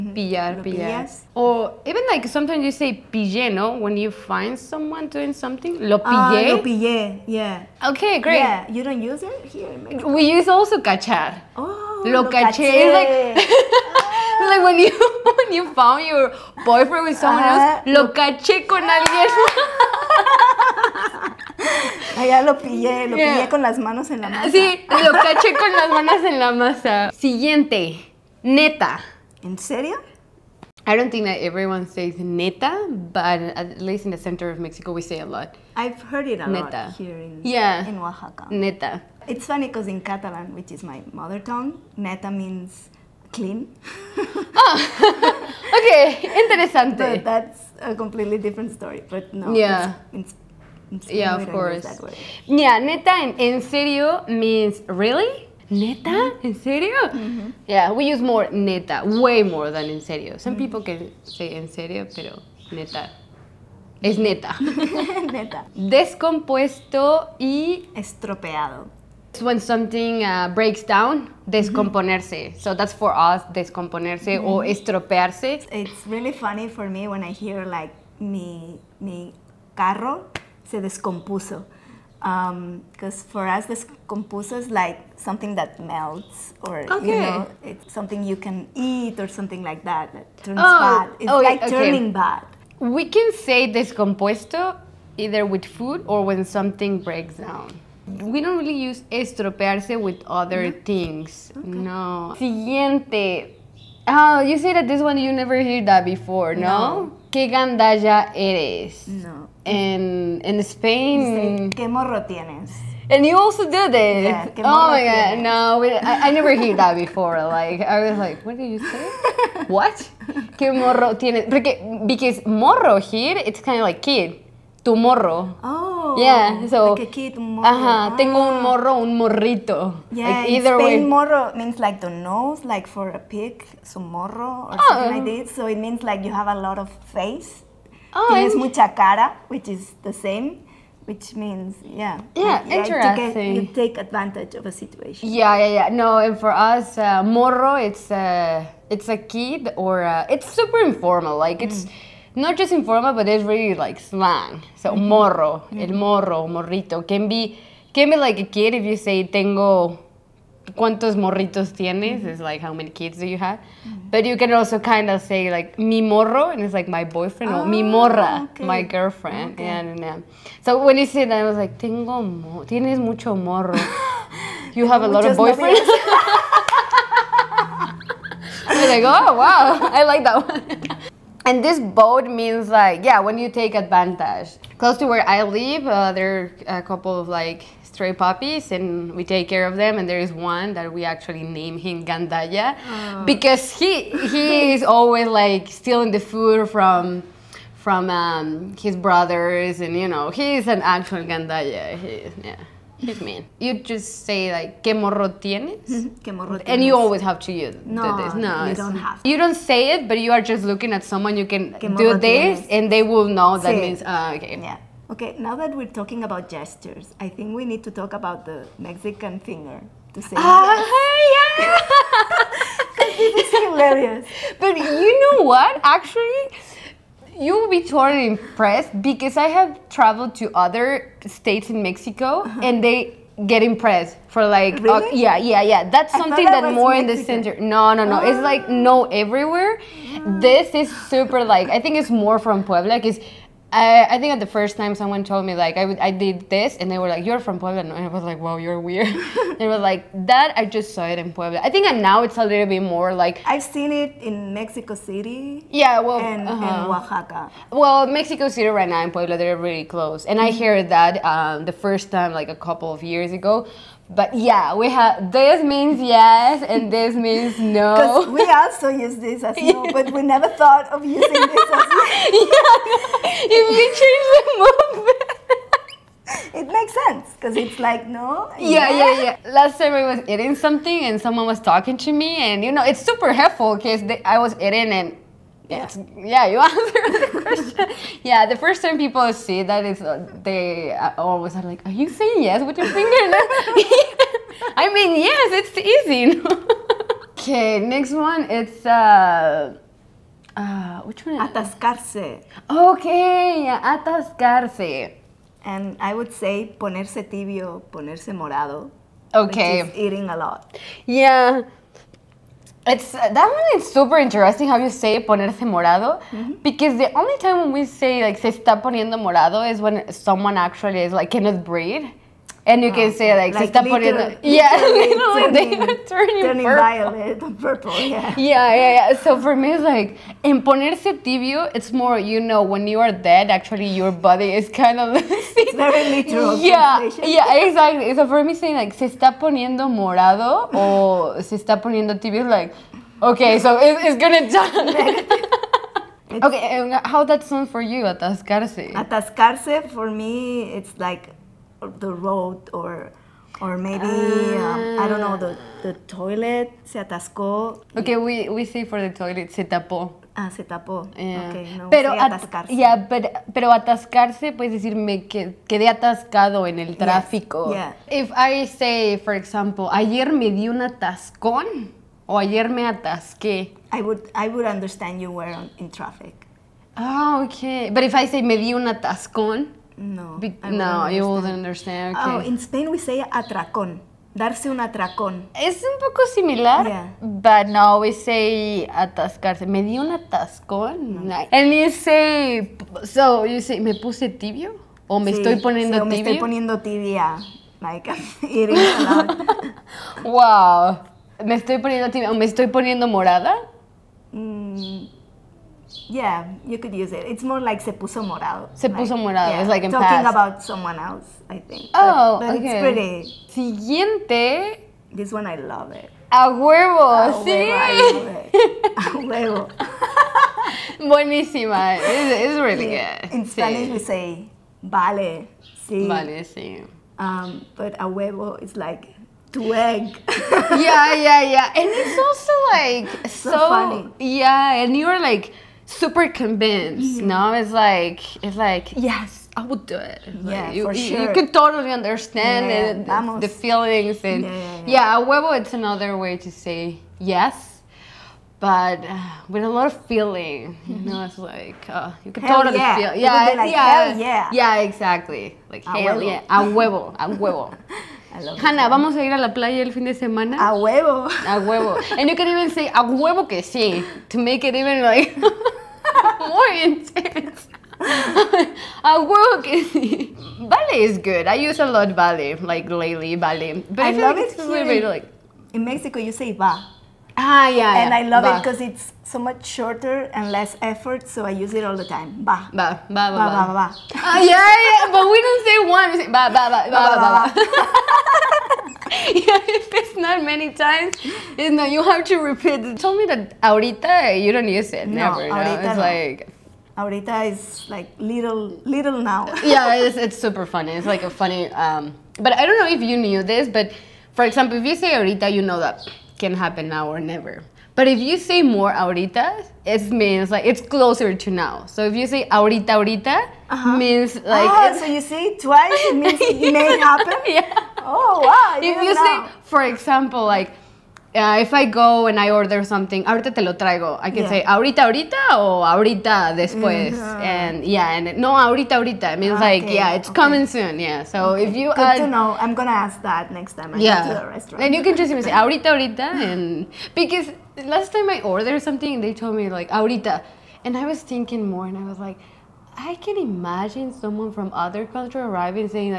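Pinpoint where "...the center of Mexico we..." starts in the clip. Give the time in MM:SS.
00:34.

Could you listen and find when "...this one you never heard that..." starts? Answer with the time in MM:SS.
01:44.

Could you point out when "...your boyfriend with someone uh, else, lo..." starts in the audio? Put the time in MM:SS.
00:16.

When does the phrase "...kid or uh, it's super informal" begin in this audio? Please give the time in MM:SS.
02:29.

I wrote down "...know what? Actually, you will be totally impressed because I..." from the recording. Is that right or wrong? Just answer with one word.
right.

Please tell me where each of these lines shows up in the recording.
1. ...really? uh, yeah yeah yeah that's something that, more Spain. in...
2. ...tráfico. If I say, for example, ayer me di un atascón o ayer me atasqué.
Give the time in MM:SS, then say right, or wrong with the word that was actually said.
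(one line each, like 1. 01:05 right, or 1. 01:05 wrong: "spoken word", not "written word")
1. 03:54 wrong: "Mexican", not "Spain"
2. 06:06 right.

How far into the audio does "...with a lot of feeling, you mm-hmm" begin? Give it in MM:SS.
07:29.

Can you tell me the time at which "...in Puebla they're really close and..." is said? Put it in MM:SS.
04:19.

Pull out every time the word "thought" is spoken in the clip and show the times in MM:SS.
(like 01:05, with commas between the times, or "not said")
04:30.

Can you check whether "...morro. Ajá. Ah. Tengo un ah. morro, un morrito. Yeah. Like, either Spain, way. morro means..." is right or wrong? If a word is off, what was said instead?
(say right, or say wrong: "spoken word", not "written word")
right.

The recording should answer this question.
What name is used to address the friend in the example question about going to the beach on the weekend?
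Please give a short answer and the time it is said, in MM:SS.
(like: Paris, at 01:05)
Hanna, at 07:38.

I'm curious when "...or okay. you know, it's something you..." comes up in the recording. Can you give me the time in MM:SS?
01:26.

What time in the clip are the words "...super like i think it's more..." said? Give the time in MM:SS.
04:01.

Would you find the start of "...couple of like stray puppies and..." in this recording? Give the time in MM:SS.
03:06.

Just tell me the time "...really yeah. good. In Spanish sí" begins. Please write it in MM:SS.
07:02.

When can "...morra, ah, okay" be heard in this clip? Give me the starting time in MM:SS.
02:47.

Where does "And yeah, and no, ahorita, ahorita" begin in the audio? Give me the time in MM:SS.
08:47.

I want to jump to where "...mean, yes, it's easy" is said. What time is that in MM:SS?
04:54.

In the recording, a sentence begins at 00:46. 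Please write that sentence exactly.
But that's a completely different story.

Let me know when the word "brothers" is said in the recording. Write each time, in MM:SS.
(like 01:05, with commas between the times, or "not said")
03:18.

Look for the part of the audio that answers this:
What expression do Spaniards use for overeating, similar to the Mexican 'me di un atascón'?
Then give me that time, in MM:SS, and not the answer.
06:24.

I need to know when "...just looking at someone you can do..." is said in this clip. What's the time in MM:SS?
03:30.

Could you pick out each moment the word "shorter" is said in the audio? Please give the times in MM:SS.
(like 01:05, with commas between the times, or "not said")
07:59.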